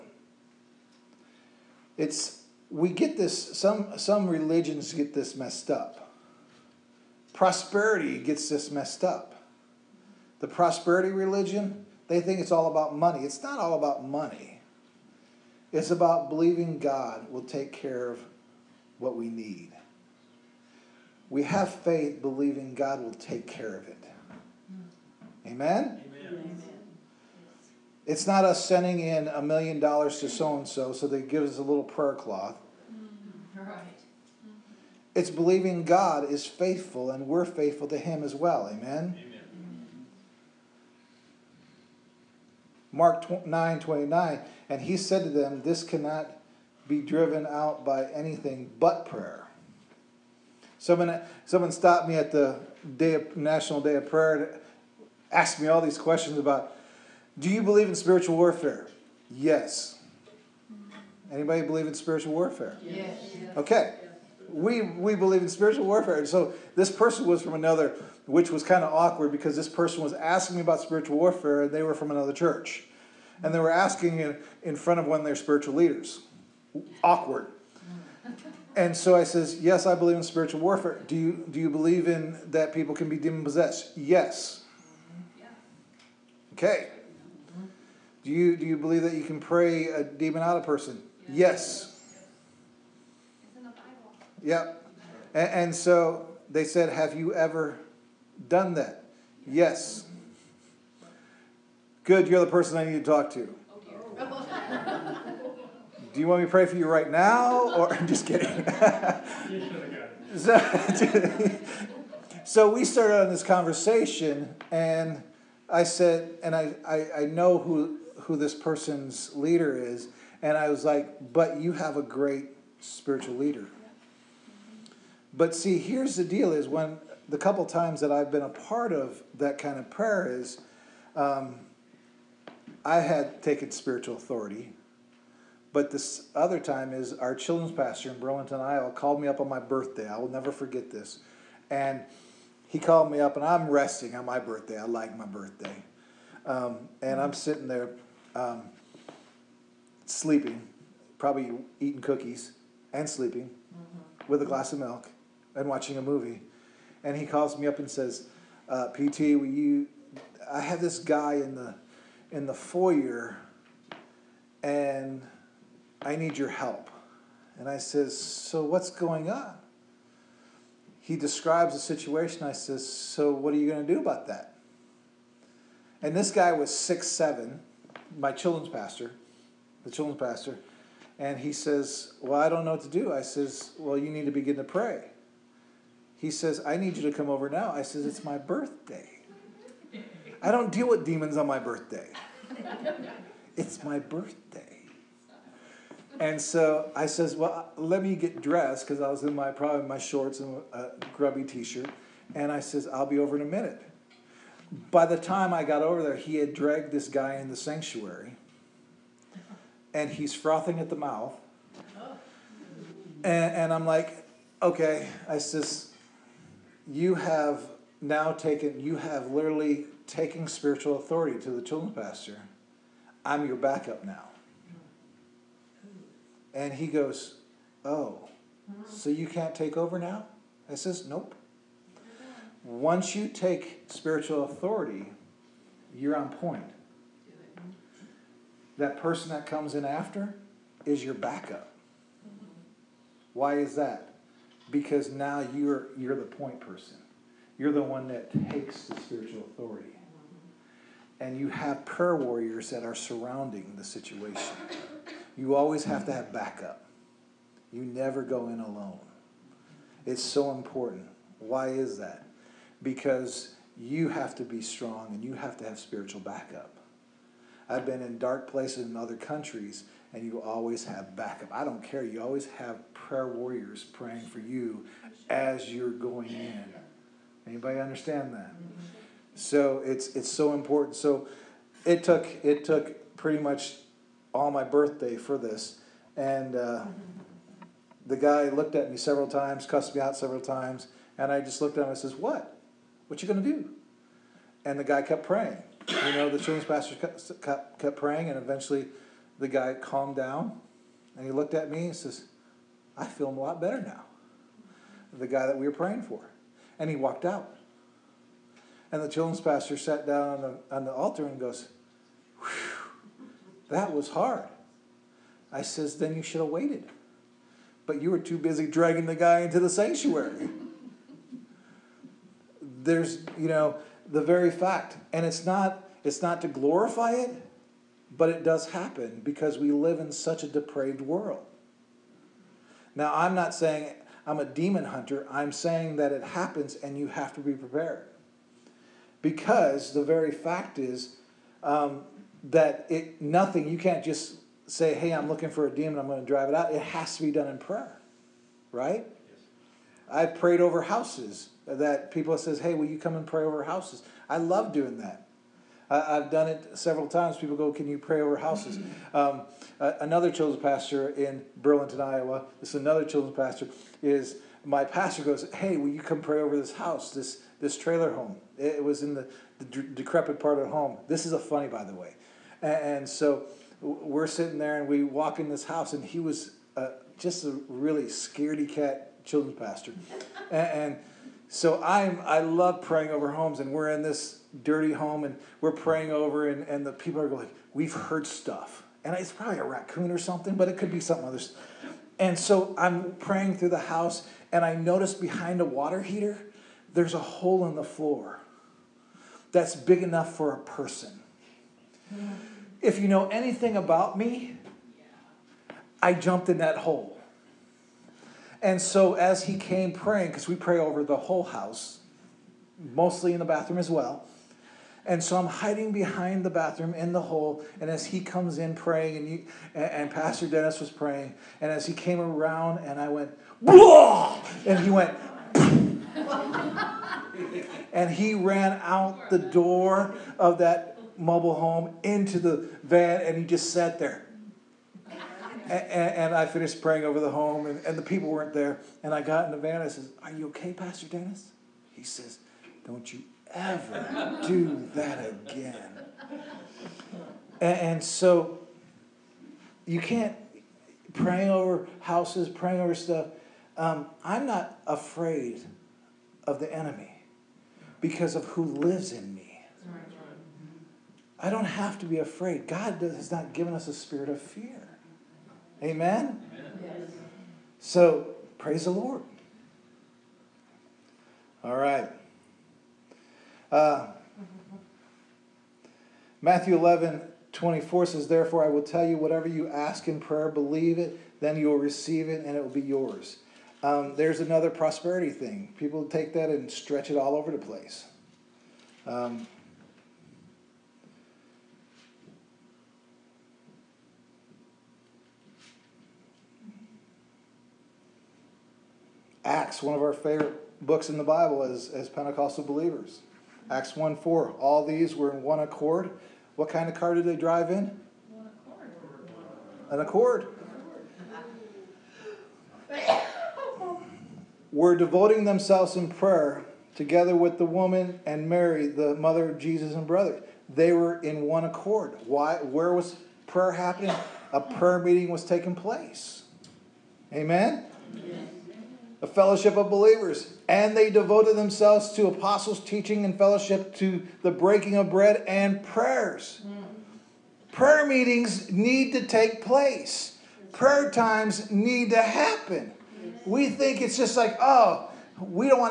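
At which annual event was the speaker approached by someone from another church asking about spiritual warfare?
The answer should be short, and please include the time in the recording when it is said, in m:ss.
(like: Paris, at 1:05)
National Day of Prayer, at 0:53.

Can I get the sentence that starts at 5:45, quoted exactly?
I'm going to drive it out." It has to be done in prayer, right?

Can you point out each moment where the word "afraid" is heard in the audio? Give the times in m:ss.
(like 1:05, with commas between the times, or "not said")
7:34, 7:42.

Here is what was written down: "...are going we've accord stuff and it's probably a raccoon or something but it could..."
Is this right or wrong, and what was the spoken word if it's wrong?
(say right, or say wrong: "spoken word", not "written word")
wrong: "heard", not "accord".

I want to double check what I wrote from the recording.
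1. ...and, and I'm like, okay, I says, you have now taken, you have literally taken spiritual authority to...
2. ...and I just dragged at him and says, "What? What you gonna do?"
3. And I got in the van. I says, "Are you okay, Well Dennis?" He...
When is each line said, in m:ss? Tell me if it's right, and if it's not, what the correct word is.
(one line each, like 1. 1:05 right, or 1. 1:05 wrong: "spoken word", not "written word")
1. 3:33 right
2. 4:51 wrong: "looked", not "dragged"
3. 7:19 wrong: "Pastor", not "Well".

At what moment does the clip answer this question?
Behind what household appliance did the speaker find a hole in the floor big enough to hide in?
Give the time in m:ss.
6:35.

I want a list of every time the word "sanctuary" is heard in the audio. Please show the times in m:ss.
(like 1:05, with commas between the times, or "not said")
3:27, 5:19.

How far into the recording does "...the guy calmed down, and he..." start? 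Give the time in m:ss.
4:59.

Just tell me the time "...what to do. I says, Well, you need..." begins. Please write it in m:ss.
3:02.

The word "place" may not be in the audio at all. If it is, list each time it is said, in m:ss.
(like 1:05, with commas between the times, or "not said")
4:28, 8:07, 8:45, 8:59.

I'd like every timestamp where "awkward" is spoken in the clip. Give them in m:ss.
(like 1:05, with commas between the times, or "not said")
1:08, 1:17.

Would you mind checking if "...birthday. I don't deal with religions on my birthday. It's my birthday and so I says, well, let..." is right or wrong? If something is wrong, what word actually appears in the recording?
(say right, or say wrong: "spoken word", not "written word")
wrong: "demons", not "religions".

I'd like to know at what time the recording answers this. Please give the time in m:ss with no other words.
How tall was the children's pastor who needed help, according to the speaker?
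2:56.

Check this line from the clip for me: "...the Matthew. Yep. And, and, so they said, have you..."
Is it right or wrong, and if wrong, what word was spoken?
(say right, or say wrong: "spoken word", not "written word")
wrong: "Bible", not "Matthew".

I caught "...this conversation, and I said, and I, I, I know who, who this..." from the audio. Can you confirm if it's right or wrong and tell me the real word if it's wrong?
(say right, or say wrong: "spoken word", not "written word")
right.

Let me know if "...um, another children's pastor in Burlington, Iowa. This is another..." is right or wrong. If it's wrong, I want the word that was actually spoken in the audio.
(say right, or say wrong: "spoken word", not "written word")
right.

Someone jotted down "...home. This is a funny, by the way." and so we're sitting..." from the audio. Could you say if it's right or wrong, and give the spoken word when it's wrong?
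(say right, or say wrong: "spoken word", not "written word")
right.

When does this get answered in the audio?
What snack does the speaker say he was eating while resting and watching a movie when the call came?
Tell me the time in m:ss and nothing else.
2:32.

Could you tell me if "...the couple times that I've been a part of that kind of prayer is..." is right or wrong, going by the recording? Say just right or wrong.
right.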